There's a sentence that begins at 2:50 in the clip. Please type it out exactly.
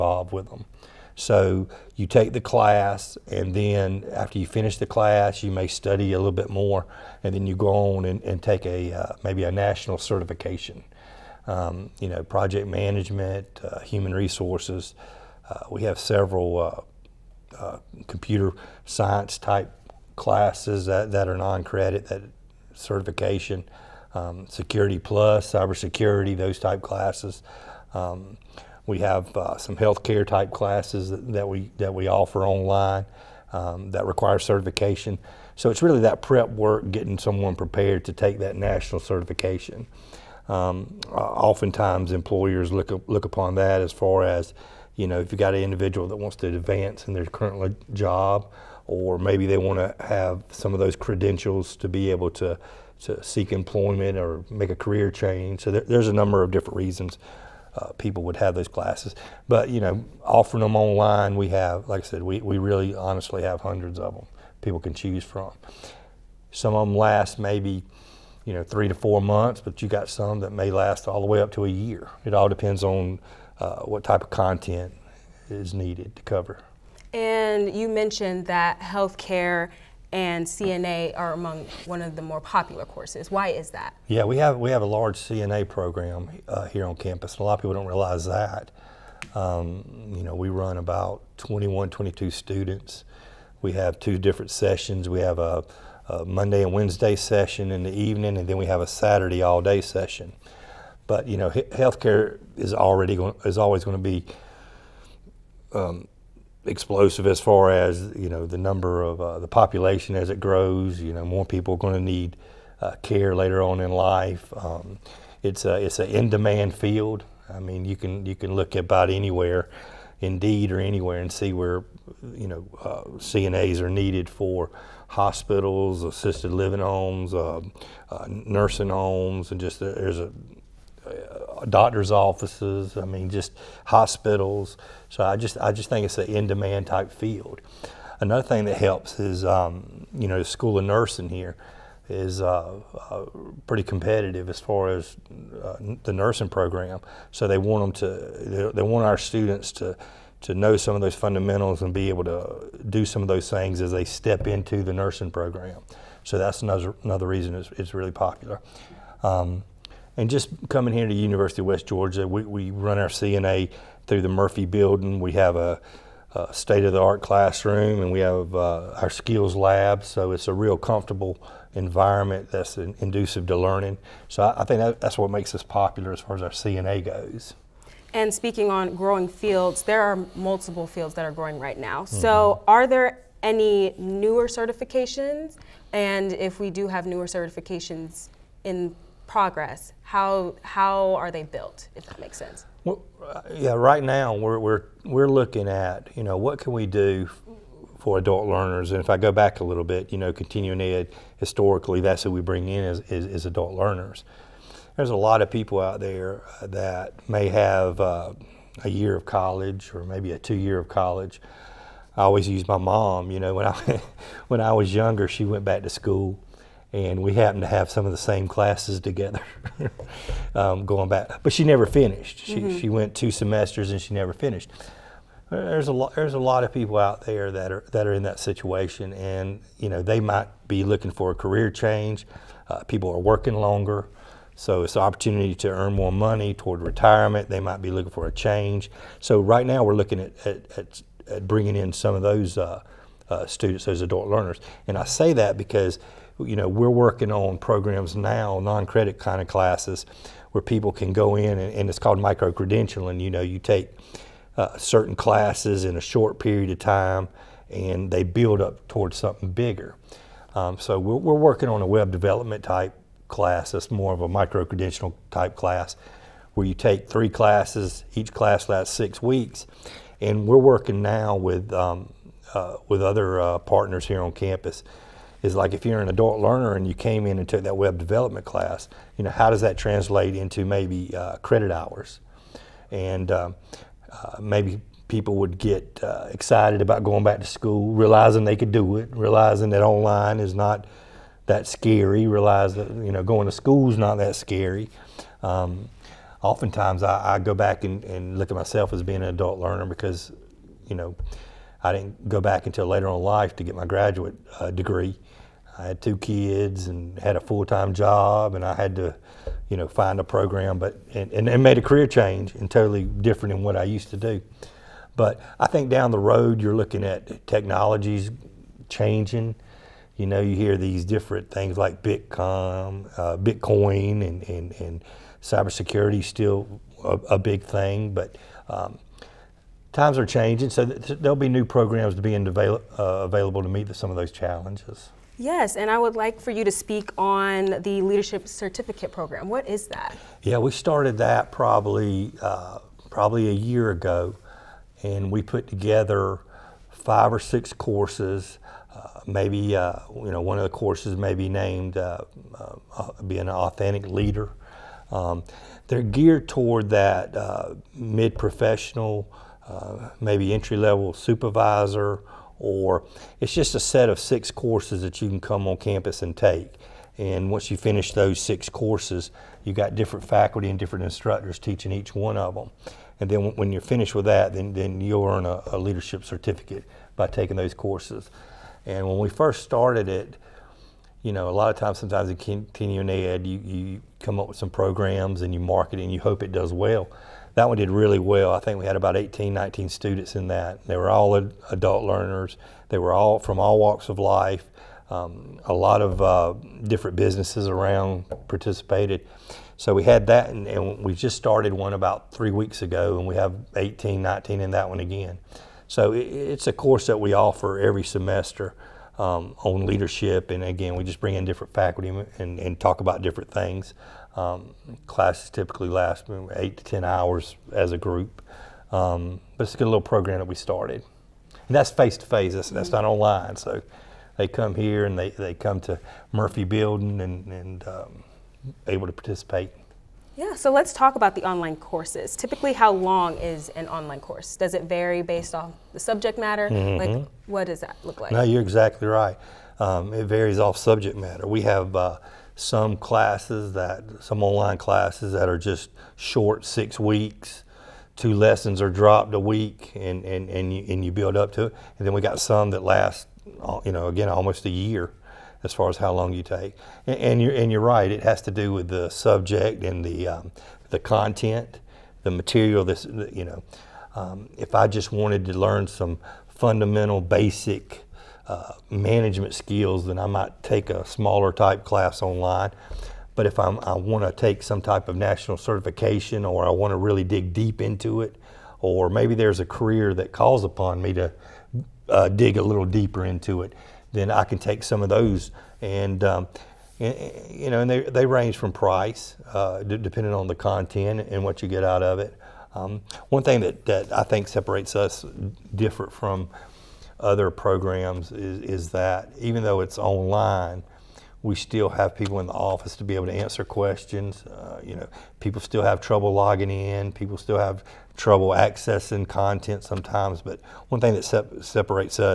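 So it's a real comfortable environment that's in, inducive to learning.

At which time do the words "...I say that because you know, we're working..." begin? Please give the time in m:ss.
4:04.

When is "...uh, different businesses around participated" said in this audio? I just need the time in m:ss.
6:36.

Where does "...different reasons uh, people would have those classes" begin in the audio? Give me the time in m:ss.
0:56.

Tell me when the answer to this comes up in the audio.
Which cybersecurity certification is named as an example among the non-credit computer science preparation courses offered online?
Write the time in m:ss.
0:24.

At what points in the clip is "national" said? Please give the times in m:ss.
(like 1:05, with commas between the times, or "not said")
0:09, 0:38, 7:55.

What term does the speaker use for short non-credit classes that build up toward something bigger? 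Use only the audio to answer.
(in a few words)
micro-credentialing.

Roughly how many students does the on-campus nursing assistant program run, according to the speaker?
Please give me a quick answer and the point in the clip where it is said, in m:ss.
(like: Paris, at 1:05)
21, 22, at 1:31.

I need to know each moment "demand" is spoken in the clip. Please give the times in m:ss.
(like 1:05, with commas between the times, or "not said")
1:56, 2:16.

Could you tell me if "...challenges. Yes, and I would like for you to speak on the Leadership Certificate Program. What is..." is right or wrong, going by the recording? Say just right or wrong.
right.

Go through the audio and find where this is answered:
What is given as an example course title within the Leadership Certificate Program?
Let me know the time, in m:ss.
5:53.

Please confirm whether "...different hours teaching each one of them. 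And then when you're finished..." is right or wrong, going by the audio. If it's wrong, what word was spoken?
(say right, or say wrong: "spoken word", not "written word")
wrong: "instructors", not "hours".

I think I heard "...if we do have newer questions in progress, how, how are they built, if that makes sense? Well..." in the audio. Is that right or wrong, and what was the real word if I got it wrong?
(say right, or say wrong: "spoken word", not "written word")
wrong: "certifications", not "questions".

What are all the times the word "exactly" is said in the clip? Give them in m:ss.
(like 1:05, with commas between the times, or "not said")
7:18.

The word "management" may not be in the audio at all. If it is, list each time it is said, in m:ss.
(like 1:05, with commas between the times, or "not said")
0:12, 7:48.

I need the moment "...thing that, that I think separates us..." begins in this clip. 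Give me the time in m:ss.
8:13.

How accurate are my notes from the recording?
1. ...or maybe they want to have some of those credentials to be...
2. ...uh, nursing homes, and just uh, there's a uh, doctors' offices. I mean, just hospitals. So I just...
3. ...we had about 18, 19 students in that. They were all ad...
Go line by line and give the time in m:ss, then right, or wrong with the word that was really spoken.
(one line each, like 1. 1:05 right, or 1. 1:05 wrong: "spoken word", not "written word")
1. 0:48 right
2. 2:08 right
3. 6:28 right.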